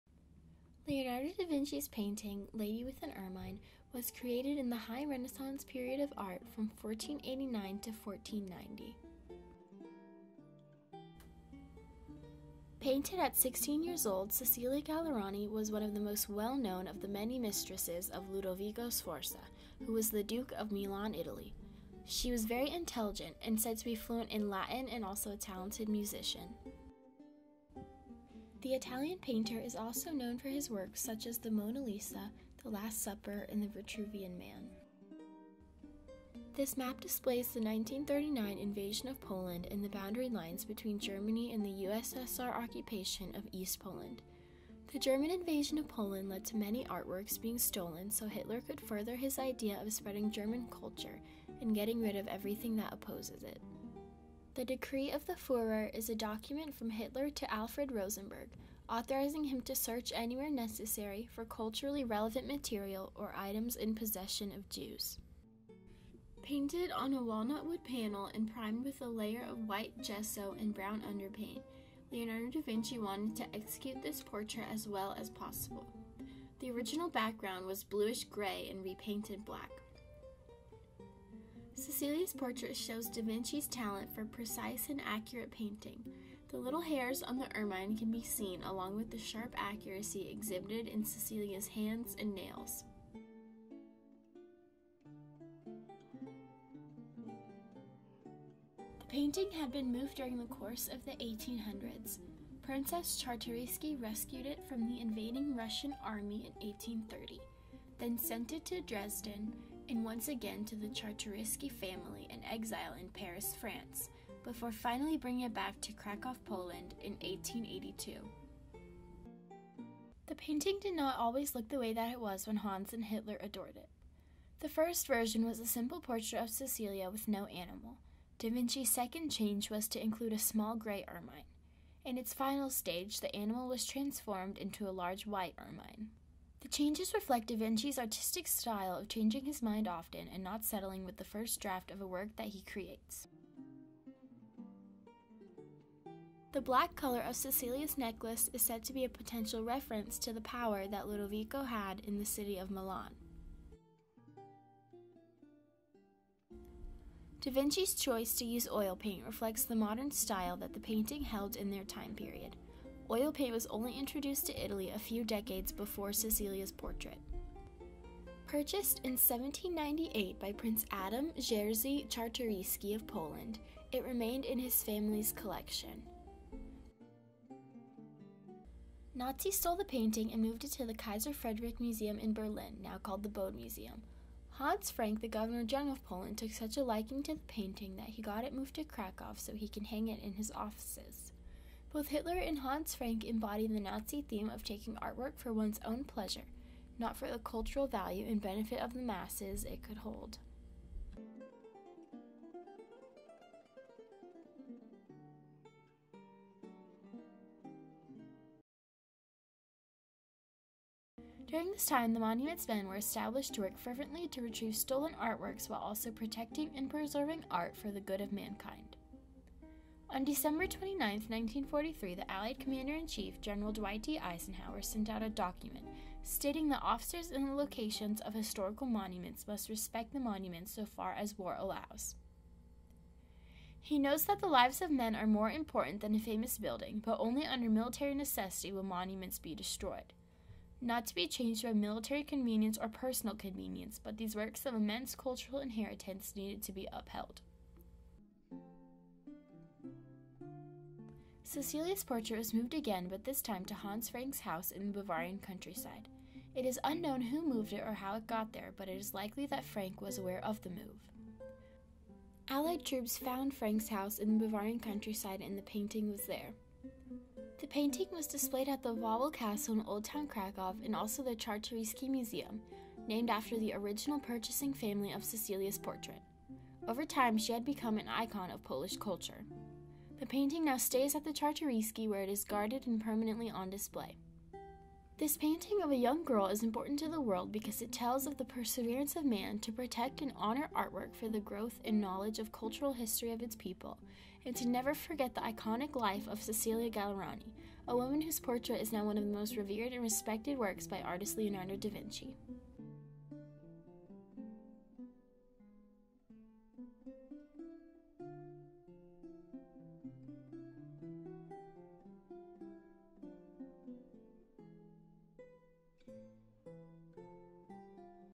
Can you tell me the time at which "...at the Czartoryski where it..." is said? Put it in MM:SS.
04:41.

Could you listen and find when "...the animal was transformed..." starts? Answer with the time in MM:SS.
02:13.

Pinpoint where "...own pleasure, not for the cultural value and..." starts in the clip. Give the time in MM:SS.
03:15.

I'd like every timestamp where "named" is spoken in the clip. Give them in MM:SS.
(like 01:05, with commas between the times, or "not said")
04:33.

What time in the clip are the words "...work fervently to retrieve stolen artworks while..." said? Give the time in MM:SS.
03:33.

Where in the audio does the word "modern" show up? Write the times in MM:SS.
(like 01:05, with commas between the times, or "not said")
02:39.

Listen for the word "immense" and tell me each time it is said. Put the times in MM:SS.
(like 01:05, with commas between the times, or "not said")
04:04.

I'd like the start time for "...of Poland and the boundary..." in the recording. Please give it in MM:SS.
00:39.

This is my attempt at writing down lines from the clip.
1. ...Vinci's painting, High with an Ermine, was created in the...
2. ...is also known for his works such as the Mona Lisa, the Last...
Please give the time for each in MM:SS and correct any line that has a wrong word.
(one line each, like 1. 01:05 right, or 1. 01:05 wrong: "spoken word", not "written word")
1. 00:01 wrong: "Lady", not "High"
2. 00:29 right.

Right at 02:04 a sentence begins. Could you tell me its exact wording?
The first version was a simple portrait of Cecilia with no animal.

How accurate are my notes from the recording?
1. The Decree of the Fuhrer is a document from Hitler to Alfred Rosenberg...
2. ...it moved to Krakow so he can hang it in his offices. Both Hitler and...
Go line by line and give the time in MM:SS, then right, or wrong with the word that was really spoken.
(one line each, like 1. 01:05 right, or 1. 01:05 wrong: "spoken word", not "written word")
1. 00:54 right
2. 03:08 right.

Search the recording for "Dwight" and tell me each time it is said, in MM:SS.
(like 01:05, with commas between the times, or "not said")
03:43.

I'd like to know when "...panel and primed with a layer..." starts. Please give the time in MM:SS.
01:07.